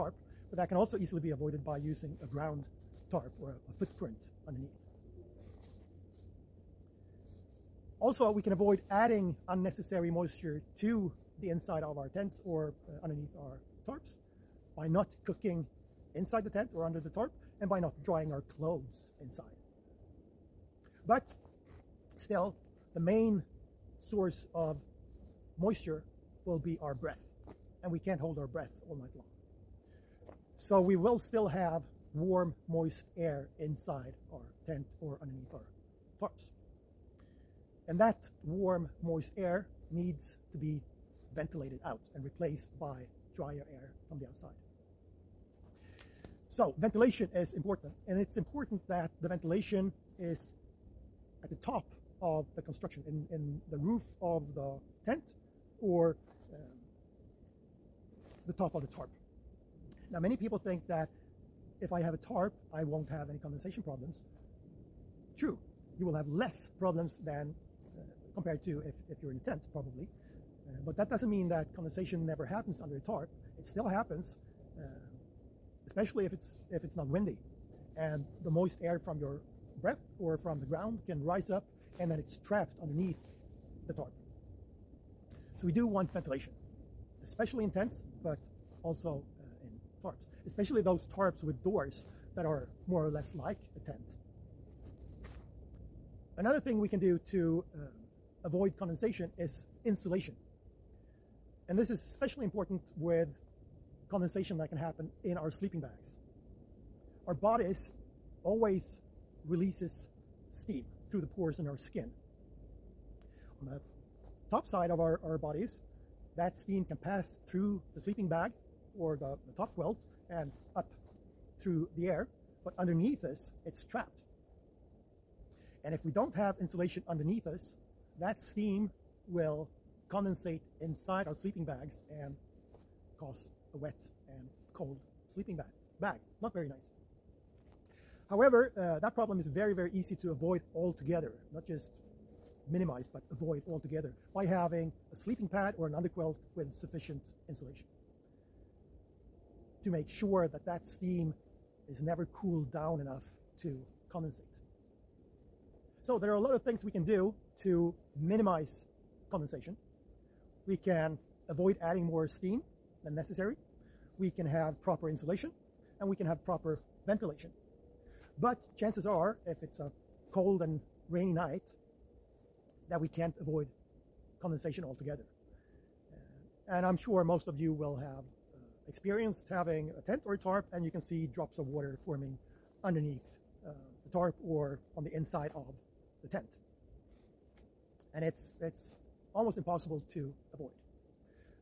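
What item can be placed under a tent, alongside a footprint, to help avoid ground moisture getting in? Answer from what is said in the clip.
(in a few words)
A ground tarp.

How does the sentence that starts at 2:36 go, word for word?
So there are a lot of things we can do to minimize condensation.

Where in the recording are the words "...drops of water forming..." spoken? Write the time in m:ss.
3:01.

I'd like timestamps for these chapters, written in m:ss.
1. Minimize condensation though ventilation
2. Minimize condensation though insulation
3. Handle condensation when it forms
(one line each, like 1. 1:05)
1. 0:21
2. 1:35
3. 2:35.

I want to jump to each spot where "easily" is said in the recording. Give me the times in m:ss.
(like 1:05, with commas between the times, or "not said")
0:00.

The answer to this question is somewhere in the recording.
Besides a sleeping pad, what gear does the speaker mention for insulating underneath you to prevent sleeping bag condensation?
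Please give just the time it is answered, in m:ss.
2:25.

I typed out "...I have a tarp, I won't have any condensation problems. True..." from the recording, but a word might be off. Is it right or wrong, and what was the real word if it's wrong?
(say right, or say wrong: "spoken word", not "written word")
right.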